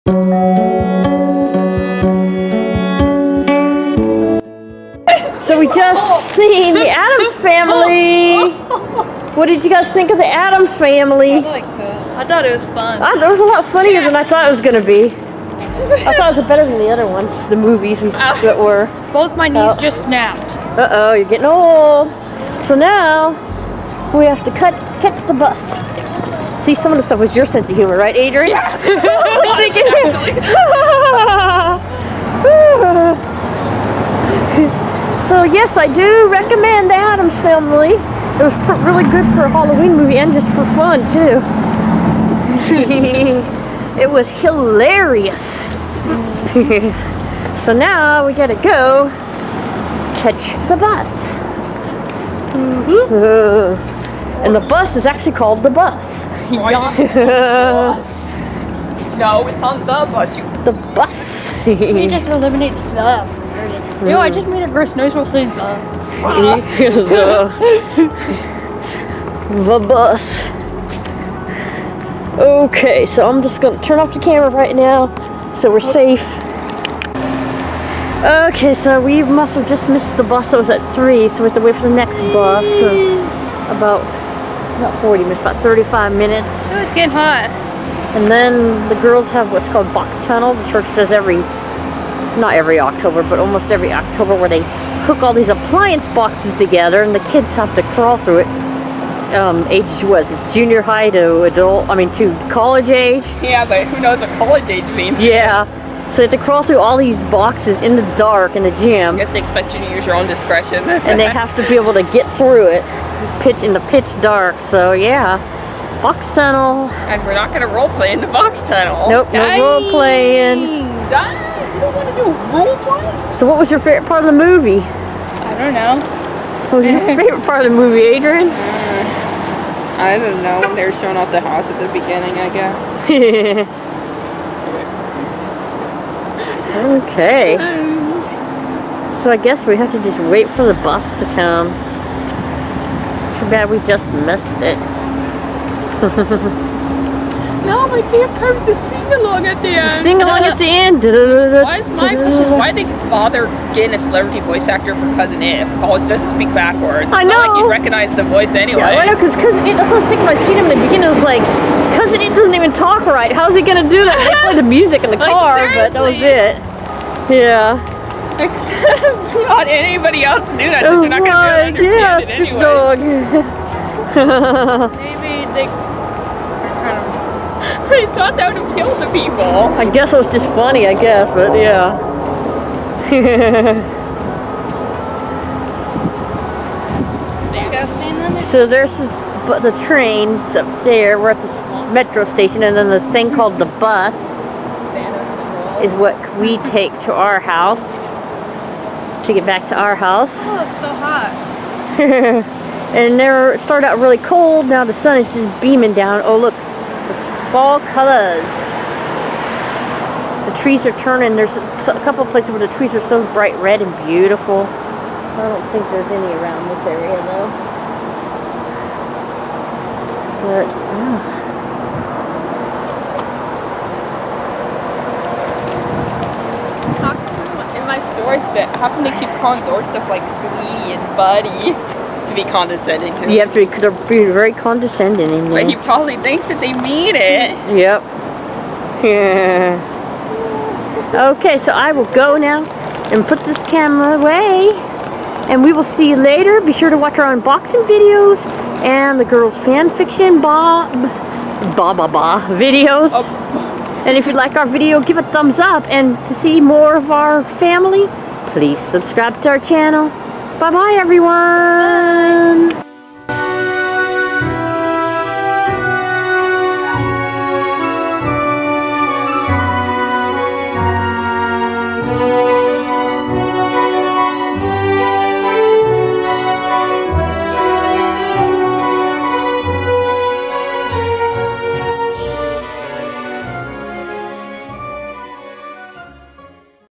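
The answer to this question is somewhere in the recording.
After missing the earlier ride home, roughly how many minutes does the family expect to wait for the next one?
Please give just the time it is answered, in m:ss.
1:25.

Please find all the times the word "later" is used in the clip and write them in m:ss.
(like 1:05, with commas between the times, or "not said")
4:06.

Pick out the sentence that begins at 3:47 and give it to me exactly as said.
In my stores, but how come they keep calling door stuff like sweetie and buddy?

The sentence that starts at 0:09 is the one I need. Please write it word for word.
What did you guys think of the Addams Family?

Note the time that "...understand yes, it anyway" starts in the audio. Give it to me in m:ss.
2:51.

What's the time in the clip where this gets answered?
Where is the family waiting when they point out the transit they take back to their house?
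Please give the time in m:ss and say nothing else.
3:11.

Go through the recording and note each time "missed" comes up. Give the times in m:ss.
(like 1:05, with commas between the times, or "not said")
1:19, 2:24.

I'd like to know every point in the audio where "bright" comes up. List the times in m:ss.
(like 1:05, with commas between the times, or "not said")
3:33.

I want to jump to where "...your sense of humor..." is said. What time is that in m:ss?
0:27.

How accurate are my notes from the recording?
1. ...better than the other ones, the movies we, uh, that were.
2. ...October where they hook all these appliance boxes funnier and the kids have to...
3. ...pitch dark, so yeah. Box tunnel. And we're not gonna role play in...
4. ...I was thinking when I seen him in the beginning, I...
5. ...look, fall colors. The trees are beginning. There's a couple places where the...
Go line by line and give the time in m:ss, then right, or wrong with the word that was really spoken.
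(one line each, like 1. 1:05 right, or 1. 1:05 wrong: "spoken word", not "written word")
1. 0:16 right
2. 1:33 wrong: "together", not "funnier"
3. 1:53 right
4. 2:40 right
5. 3:26 wrong: "turning", not "beginning".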